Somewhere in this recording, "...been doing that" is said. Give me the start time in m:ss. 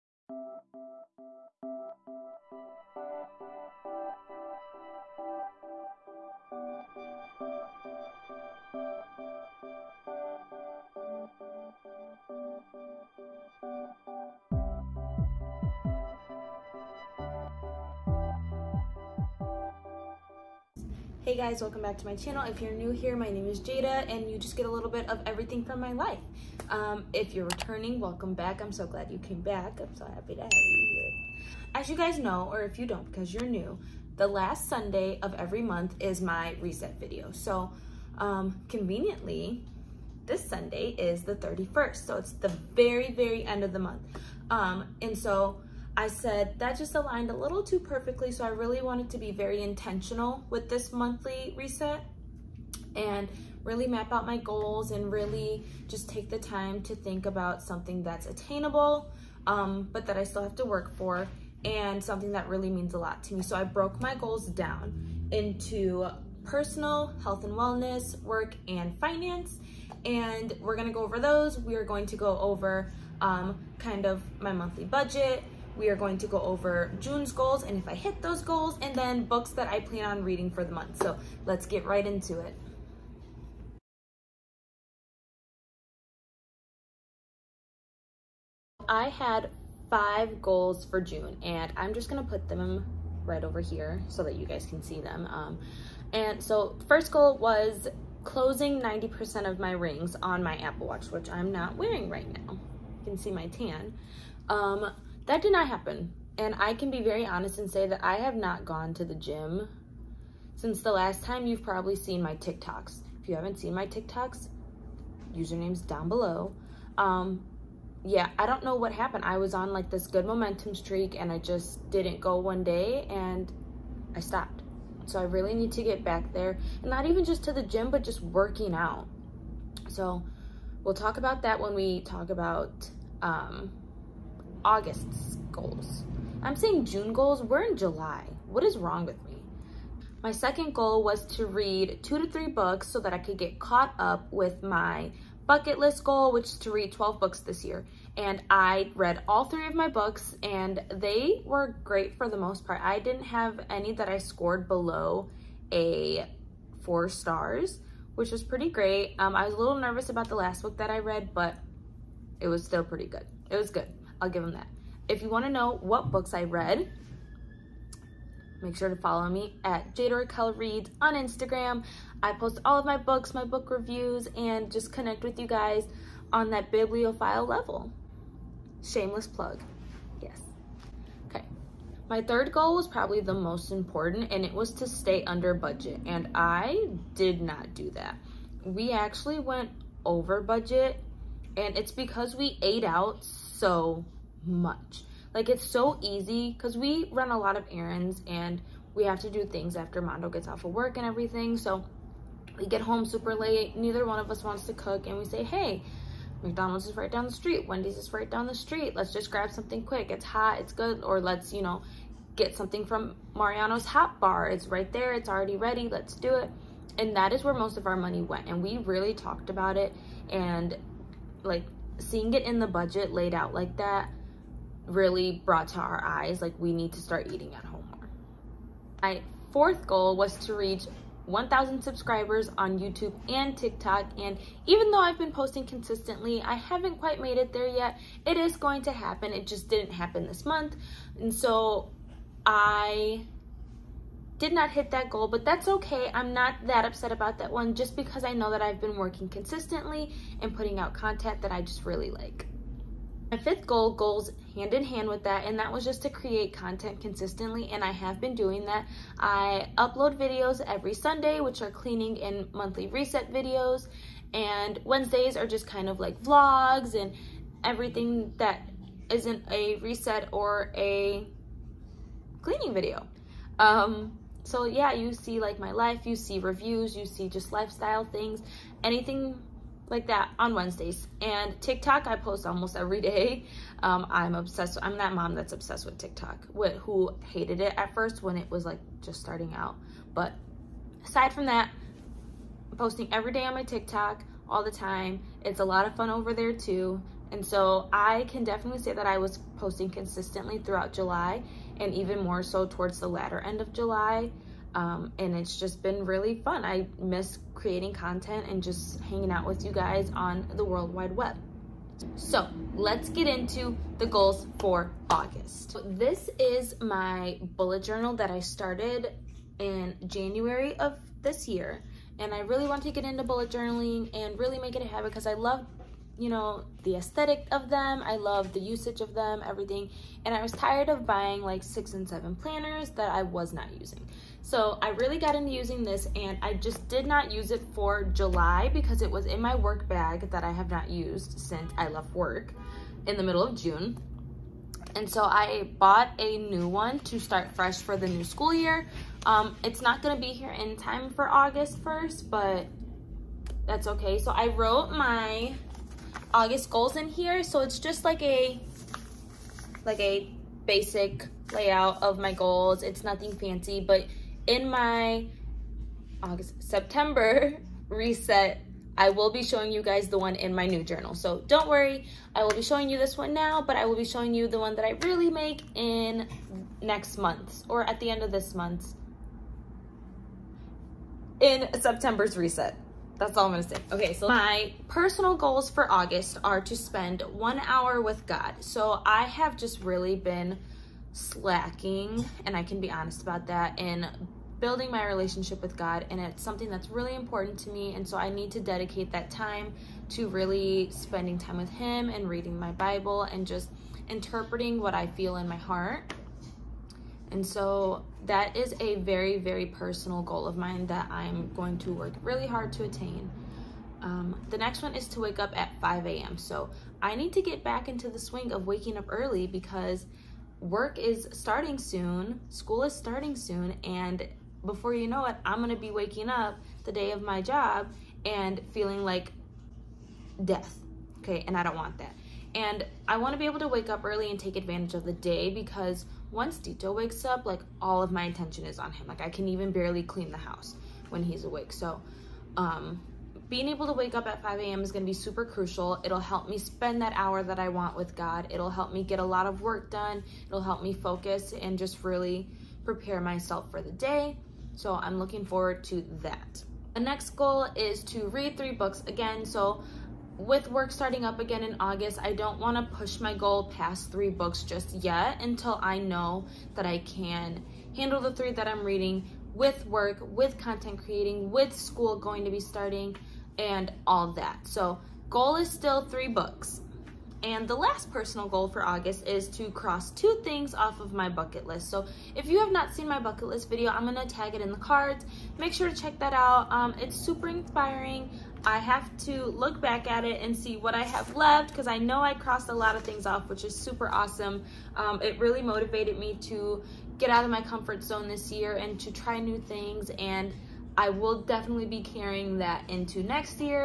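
4:18.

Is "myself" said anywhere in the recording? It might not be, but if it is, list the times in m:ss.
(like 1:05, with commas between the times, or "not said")
7:33.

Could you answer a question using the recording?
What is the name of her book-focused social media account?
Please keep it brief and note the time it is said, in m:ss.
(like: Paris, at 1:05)
Jada Raquel Reads, at 2:49.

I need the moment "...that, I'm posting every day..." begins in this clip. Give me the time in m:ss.
4:51.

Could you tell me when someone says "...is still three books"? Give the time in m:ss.
7:55.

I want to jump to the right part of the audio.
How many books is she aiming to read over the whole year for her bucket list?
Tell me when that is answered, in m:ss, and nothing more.
2:26.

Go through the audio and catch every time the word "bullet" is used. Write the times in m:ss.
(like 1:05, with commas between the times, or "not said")
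5:17, 5:23.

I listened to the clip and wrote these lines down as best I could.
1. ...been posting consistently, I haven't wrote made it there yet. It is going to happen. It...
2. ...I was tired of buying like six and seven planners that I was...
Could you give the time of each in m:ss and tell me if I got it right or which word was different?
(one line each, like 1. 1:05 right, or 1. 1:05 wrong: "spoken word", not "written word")
1. 3:55 wrong: "quite", not "wrote"
2. 5:30 right.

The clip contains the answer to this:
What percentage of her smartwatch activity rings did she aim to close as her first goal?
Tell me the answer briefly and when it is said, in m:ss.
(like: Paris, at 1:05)
90%, at 1:38.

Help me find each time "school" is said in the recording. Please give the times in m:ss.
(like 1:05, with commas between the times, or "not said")
5:48, 7:02, 7:51.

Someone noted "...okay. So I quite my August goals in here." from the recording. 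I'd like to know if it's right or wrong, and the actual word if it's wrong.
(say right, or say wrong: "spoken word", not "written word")
wrong: "wrote", not "quite".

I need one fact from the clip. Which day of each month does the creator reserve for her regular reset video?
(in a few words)
Last Sunday.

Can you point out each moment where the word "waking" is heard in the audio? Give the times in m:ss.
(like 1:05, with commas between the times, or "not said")
6:58, 7:05.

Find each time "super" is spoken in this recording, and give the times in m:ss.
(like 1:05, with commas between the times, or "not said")
3:23, 7:25, 8:07, 8:13.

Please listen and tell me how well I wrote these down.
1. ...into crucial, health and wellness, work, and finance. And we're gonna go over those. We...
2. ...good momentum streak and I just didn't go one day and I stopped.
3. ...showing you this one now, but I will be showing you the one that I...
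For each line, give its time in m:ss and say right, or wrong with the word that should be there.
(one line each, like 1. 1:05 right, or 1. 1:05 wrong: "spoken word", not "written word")
1. 1:05 wrong: "personal", not "crucial"
2. 2:00 right
3. 6:12 right.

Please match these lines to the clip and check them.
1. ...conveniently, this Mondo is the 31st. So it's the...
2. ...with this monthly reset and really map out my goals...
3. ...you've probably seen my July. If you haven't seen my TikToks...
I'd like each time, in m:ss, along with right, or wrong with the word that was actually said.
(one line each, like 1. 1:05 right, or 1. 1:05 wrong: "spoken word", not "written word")
1. 0:38 wrong: "Sunday", not "Mondo"
2. 0:50 right
3. 1:51 wrong: "TikToks", not "July".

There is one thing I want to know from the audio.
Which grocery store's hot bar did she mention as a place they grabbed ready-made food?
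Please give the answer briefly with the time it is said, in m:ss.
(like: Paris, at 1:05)
Mariano's, at 3:33.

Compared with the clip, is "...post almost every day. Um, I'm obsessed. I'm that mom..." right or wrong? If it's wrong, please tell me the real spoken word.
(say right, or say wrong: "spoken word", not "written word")
right.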